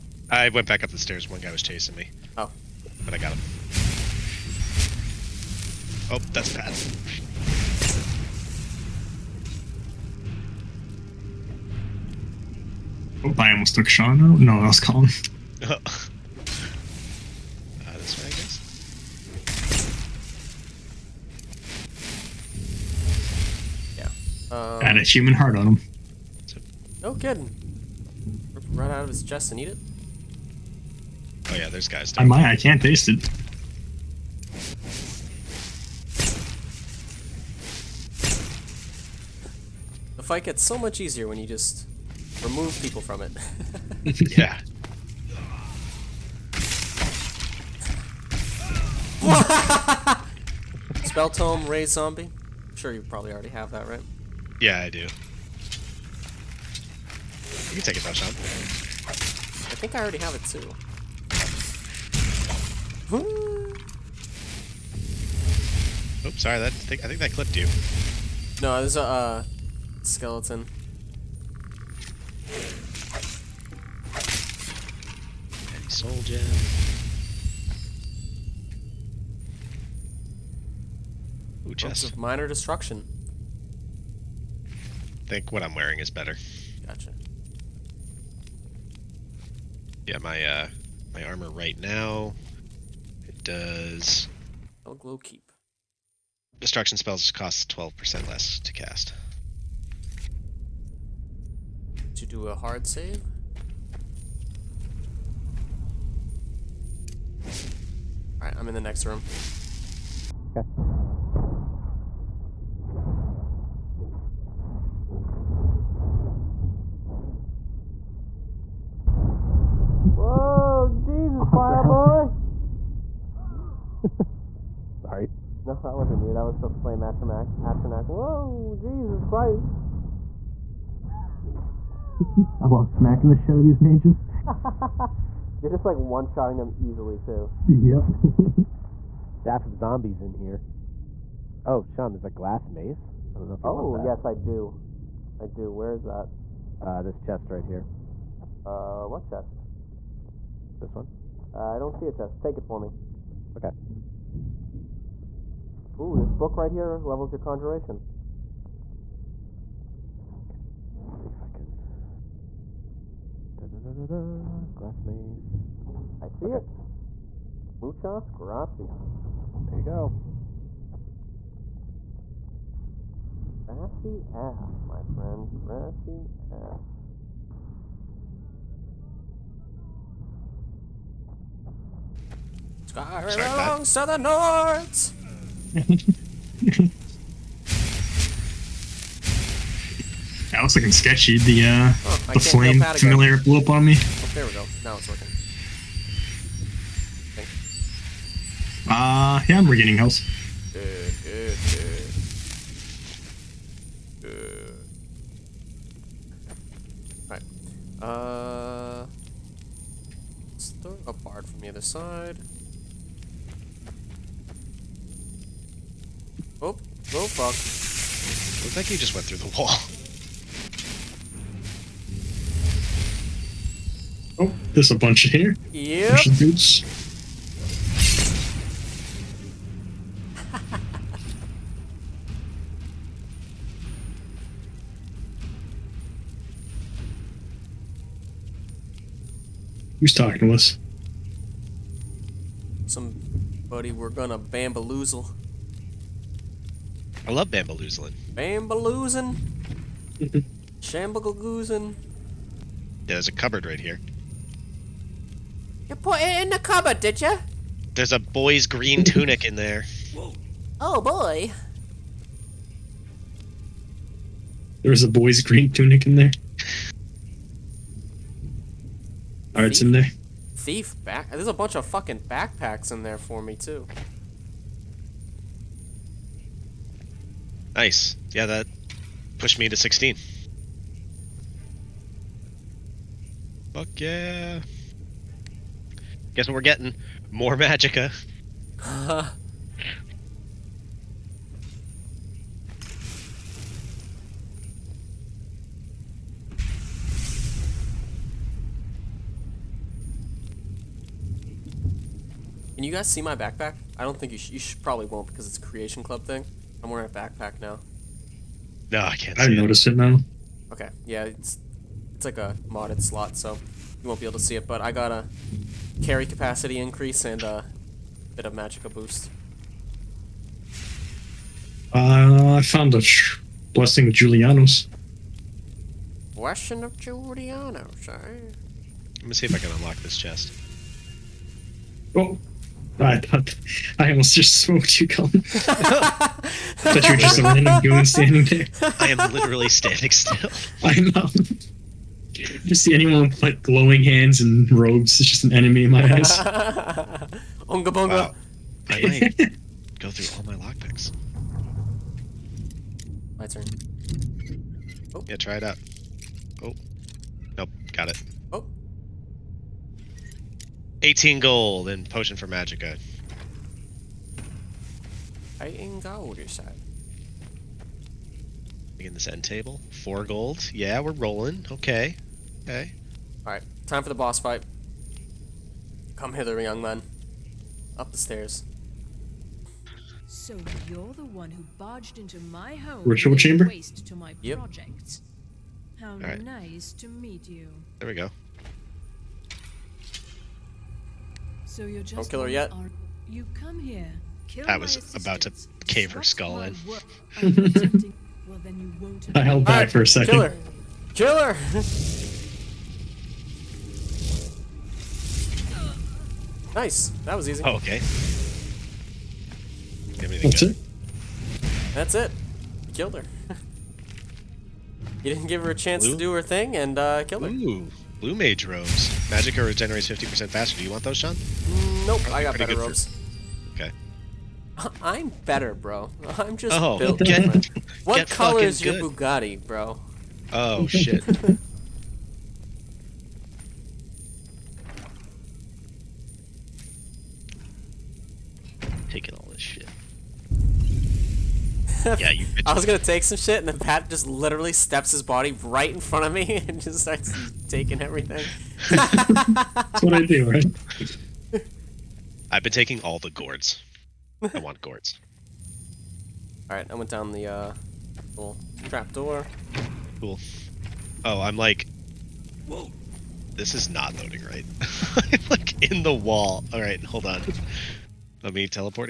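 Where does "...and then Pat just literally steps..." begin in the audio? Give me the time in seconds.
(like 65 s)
443 s.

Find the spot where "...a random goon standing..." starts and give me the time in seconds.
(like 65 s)
337 s.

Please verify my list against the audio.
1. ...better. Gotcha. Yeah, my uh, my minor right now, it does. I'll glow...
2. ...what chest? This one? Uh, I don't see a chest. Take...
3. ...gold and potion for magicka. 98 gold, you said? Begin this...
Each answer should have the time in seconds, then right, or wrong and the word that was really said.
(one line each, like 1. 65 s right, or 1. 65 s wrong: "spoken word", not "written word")
1. 86 s wrong: "armor", not "minor"
2. 149 s right
3. 361 s wrong: "18", not "98".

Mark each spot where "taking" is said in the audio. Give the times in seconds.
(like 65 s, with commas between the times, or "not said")
447 s, 452 s.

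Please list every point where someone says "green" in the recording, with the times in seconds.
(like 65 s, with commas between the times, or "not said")
258 s, 265 s.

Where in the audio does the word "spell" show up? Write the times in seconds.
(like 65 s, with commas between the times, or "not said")
51 s, 96 s.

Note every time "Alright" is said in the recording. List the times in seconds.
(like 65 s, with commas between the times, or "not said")
108 s, 207 s, 269 s, 373 s.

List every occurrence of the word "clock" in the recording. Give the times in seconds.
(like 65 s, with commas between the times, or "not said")
not said.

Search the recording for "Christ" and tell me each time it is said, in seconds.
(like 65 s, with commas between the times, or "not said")
129 s.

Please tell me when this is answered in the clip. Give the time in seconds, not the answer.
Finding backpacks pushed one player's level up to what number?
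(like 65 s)
279 s.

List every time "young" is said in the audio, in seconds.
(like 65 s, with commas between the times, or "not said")
376 s.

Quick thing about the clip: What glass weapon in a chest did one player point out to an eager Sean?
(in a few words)
Glass mace.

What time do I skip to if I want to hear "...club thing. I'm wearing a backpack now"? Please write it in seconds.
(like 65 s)
306 s.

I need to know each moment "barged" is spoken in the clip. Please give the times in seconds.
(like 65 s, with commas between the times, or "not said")
381 s.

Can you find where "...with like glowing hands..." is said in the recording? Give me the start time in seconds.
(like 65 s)
343 s.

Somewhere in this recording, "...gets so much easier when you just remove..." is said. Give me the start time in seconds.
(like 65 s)
40 s.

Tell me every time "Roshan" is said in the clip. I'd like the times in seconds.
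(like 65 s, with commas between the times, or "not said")
58 s.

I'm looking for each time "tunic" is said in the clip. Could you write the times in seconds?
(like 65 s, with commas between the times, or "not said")
259 s, 265 s.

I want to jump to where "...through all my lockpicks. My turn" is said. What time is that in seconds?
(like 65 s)
350 s.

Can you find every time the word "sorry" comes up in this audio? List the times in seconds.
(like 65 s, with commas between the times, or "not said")
66 s, 125 s.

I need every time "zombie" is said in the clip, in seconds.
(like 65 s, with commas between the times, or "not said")
51 s, 139 s.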